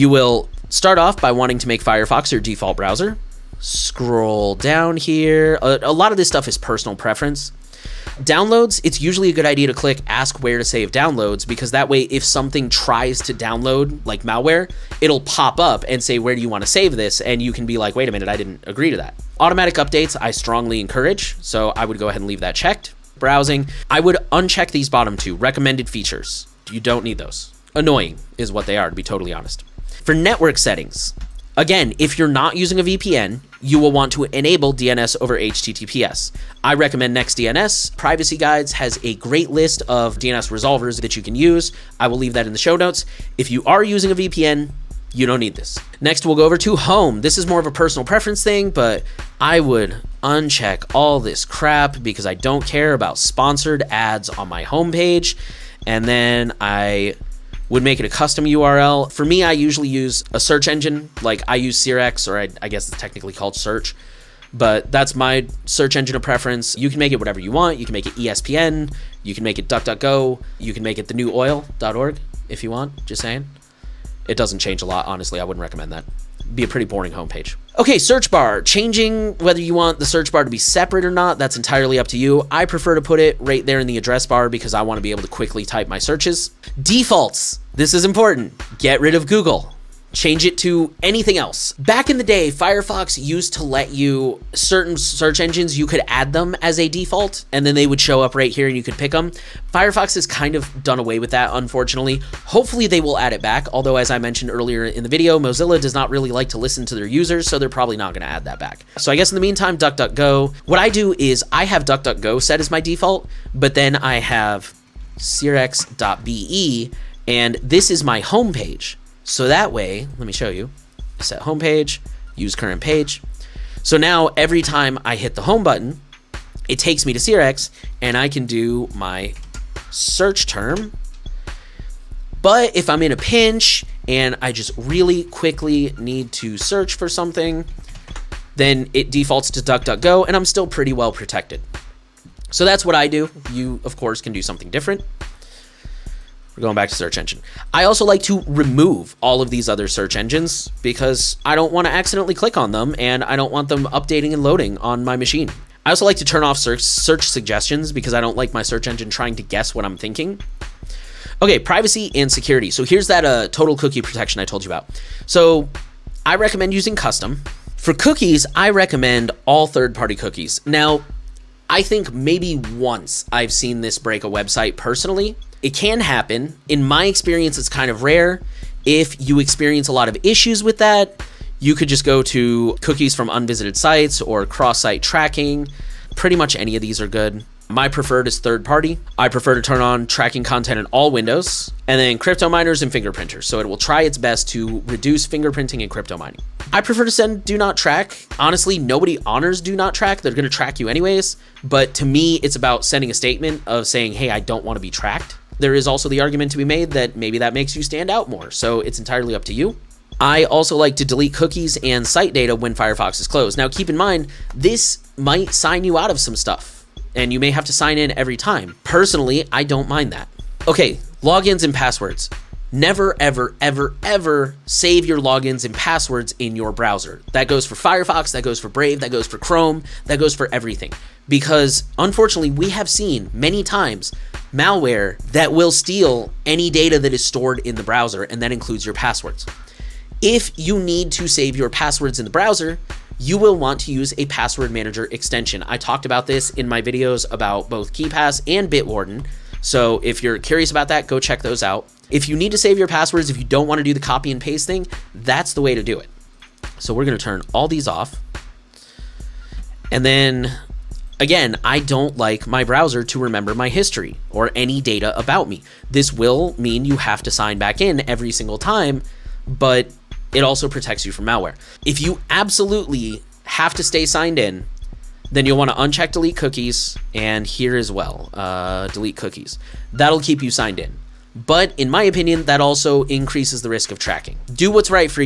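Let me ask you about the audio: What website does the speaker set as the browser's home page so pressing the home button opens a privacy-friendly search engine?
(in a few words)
searx.be.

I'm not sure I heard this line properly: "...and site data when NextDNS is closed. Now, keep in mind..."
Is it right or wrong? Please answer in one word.
wrong.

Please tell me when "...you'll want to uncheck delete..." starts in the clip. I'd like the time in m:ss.
4:35.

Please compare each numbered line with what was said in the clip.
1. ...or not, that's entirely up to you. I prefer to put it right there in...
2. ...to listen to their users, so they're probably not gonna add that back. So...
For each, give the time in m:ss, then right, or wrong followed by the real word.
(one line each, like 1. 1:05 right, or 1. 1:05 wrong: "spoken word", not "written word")
1. 1:21 right
2. 1:46 right.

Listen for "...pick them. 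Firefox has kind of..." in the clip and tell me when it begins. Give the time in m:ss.
1:38.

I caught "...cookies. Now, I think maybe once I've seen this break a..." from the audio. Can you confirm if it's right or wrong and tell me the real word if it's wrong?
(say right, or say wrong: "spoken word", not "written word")
right.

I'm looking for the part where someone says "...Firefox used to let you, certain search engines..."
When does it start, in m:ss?
1:32.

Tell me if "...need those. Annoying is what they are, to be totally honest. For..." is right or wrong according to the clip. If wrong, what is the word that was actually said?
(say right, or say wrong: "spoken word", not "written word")
right.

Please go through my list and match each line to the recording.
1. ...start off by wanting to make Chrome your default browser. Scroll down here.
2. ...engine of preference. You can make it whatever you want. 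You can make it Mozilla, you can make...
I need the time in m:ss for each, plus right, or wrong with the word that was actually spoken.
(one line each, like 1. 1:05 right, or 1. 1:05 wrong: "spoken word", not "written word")
1. 0:00 wrong: "Firefox", not "Chrome"
2. 1:05 wrong: "ESPN", not "Mozilla".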